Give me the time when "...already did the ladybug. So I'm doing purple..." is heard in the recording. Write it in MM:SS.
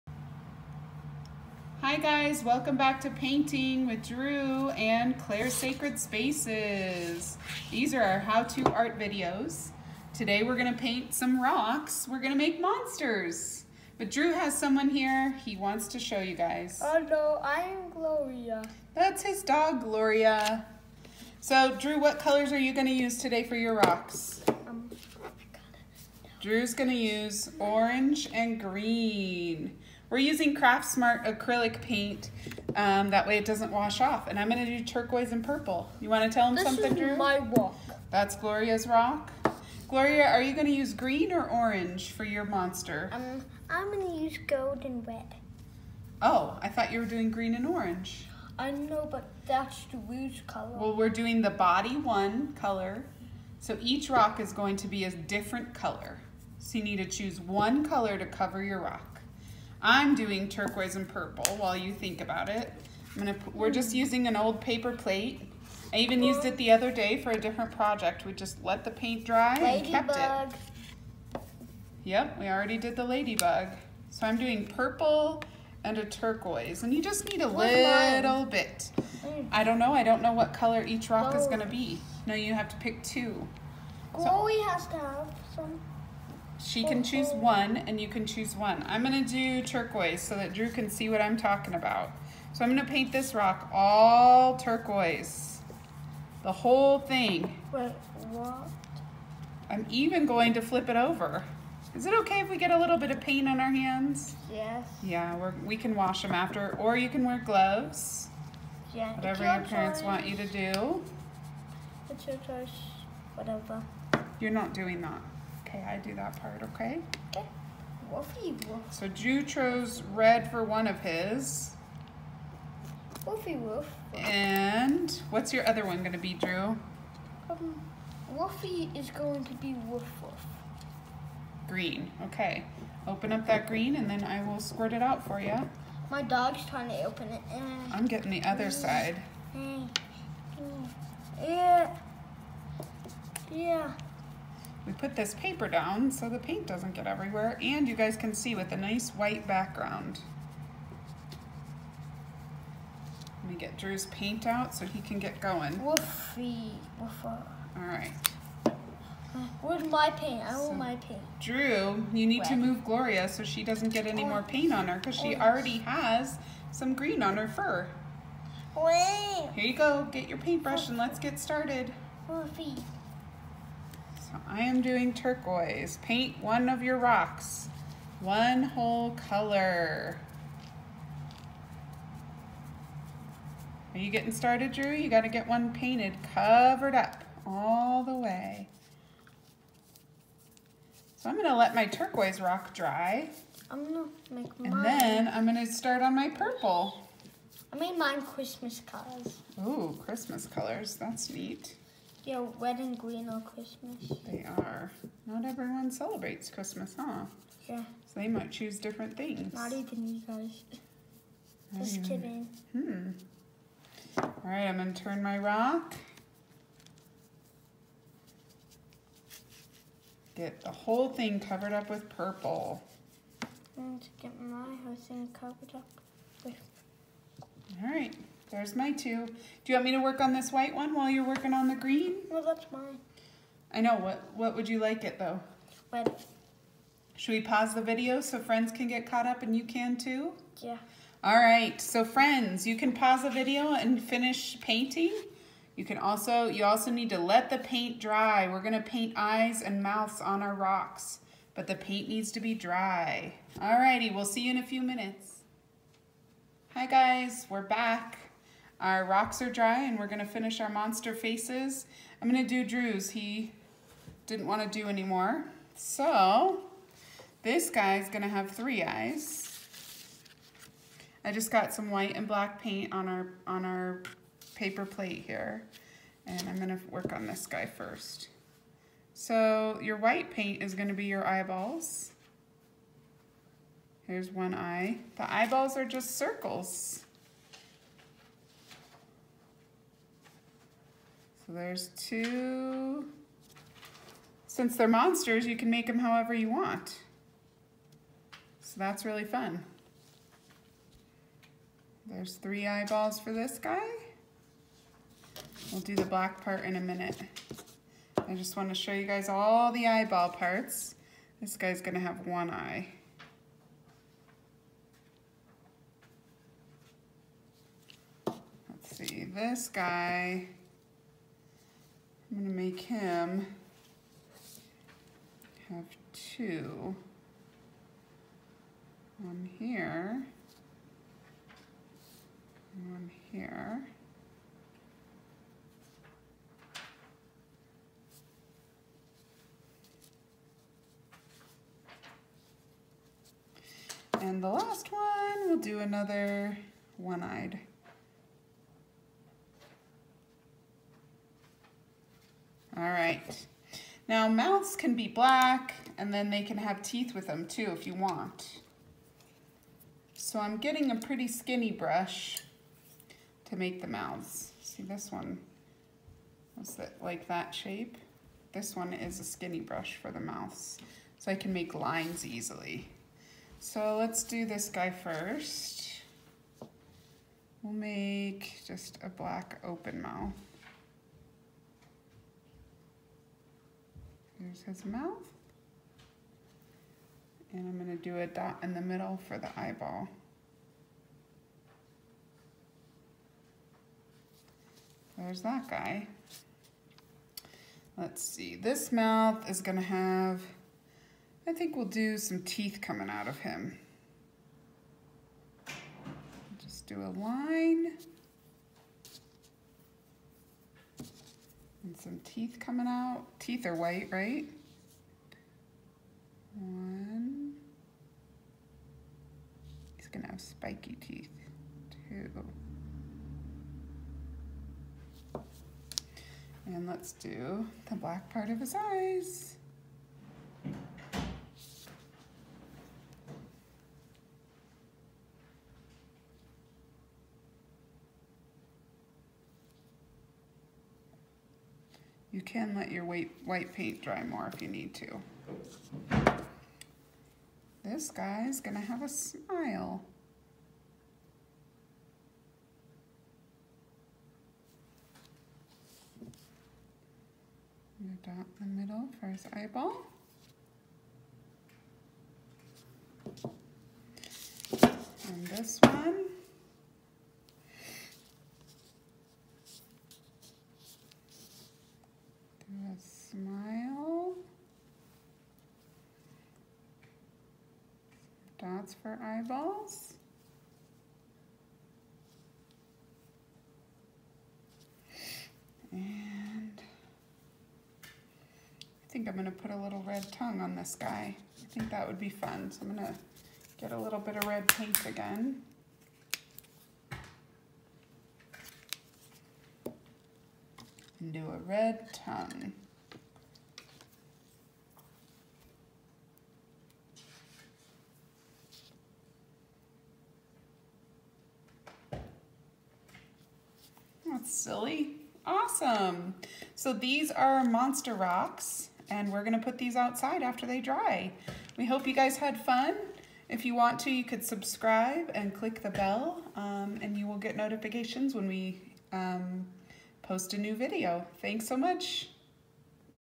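01:12.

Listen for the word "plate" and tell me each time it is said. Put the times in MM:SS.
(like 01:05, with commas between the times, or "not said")
01:04, 04:34.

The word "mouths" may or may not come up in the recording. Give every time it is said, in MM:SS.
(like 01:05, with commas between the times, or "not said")
04:09, 05:54, 06:03, 06:10, 06:20, 06:24, 06:38.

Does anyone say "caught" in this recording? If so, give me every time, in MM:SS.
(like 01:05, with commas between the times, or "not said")
03:59.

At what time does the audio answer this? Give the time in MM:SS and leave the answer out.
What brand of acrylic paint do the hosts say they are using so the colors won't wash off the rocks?
00:30.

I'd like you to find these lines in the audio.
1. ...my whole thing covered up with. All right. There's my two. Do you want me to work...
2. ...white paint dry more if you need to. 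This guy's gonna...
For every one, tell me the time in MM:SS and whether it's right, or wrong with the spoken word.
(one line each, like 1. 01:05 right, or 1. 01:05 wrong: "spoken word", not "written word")
1. 03:44 right
2. 07:23 right.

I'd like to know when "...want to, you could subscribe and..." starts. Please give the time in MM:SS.
08:43.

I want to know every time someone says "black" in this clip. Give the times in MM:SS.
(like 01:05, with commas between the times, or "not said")
04:32, 05:06, 05:55, 06:19, 07:07.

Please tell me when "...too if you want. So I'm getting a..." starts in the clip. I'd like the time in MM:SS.
05:57.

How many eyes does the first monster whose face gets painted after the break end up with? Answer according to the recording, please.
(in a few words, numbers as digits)
3.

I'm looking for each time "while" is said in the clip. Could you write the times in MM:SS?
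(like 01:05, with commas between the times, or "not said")
01:01, 03:50.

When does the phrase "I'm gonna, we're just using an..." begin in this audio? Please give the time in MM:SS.
01:03.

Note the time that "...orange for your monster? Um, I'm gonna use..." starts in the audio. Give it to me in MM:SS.
00:41.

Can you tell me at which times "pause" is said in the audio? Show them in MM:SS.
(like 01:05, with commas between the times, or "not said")
03:57, 04:02.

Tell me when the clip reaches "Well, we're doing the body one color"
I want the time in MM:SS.
00:50.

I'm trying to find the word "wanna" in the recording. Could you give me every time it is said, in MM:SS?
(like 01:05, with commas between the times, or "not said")
00:36, 04:24.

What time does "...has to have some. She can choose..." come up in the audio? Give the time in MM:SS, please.
01:24.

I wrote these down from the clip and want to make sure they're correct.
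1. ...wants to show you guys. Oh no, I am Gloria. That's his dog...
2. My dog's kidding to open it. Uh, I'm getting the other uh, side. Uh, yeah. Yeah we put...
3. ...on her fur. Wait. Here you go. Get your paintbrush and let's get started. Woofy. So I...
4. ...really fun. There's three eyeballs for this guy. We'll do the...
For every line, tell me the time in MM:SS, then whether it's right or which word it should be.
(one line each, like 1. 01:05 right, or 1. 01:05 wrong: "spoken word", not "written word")
1. 00:15 right
2. 02:16 wrong: "trying", not "kidding"
3. 02:47 right
4. 04:59 right.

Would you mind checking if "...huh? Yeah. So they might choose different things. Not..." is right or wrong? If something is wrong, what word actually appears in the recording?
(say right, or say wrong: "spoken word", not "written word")
right.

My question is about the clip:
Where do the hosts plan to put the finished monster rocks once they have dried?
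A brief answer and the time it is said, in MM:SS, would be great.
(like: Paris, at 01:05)
outside, at 08:39.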